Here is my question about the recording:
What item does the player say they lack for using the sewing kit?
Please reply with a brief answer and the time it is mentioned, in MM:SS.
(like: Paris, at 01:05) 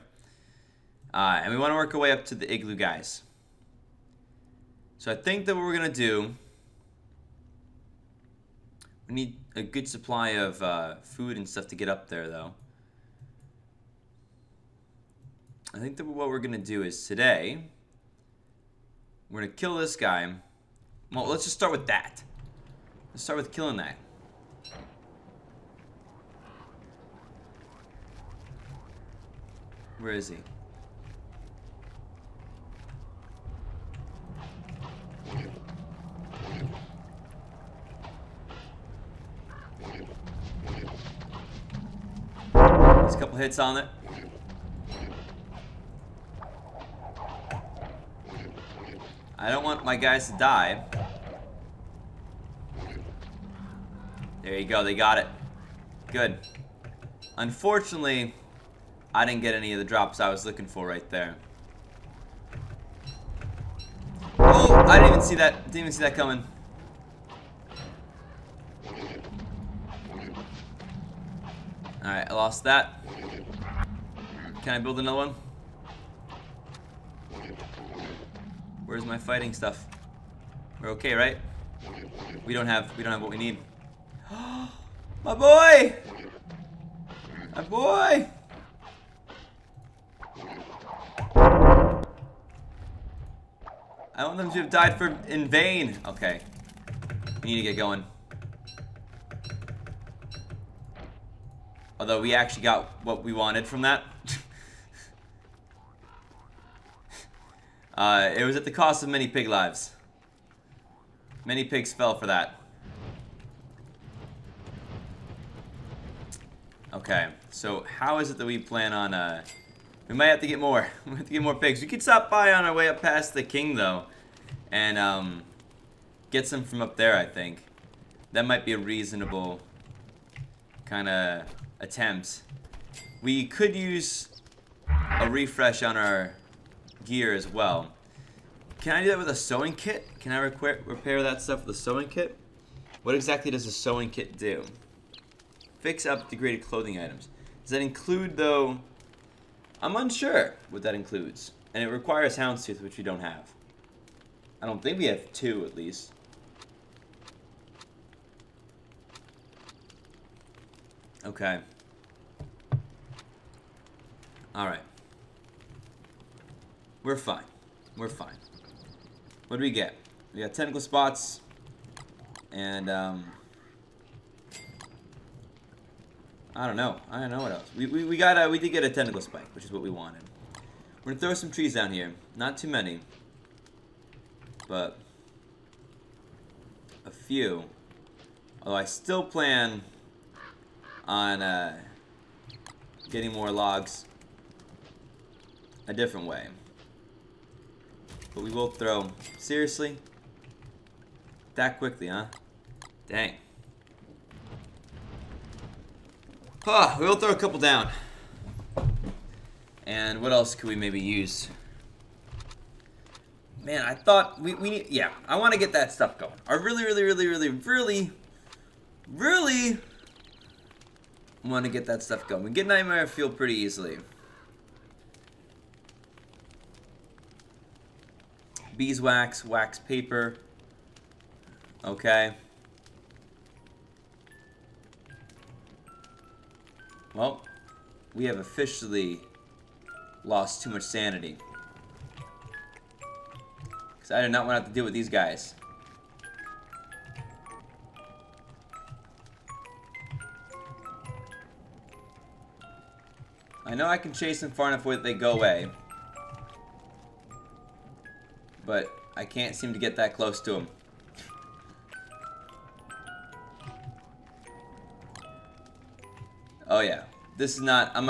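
Houndstooth, at 02:32.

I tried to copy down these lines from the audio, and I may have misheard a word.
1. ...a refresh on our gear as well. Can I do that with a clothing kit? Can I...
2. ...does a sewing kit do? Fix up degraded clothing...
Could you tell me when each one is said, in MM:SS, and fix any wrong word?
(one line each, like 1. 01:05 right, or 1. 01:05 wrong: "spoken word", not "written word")
1. 02:15 wrong: "sewing", not "clothing"
2. 02:23 right.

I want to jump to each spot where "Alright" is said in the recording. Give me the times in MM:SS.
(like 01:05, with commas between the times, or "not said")
01:11, 02:44.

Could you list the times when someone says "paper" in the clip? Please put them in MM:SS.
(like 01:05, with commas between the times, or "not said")
03:49.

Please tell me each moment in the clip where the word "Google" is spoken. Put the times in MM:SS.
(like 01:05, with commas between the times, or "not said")
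not said.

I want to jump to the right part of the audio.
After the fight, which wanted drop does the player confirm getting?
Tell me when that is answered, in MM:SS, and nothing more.
02:58.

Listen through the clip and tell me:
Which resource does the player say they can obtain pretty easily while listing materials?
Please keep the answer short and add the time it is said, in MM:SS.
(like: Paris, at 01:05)
Nightmare Fuel, at 03:42.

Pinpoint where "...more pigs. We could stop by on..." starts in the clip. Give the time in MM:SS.
02:01.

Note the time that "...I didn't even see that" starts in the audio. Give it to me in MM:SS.
01:04.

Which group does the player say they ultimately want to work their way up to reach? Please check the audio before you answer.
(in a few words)
the igloo guys.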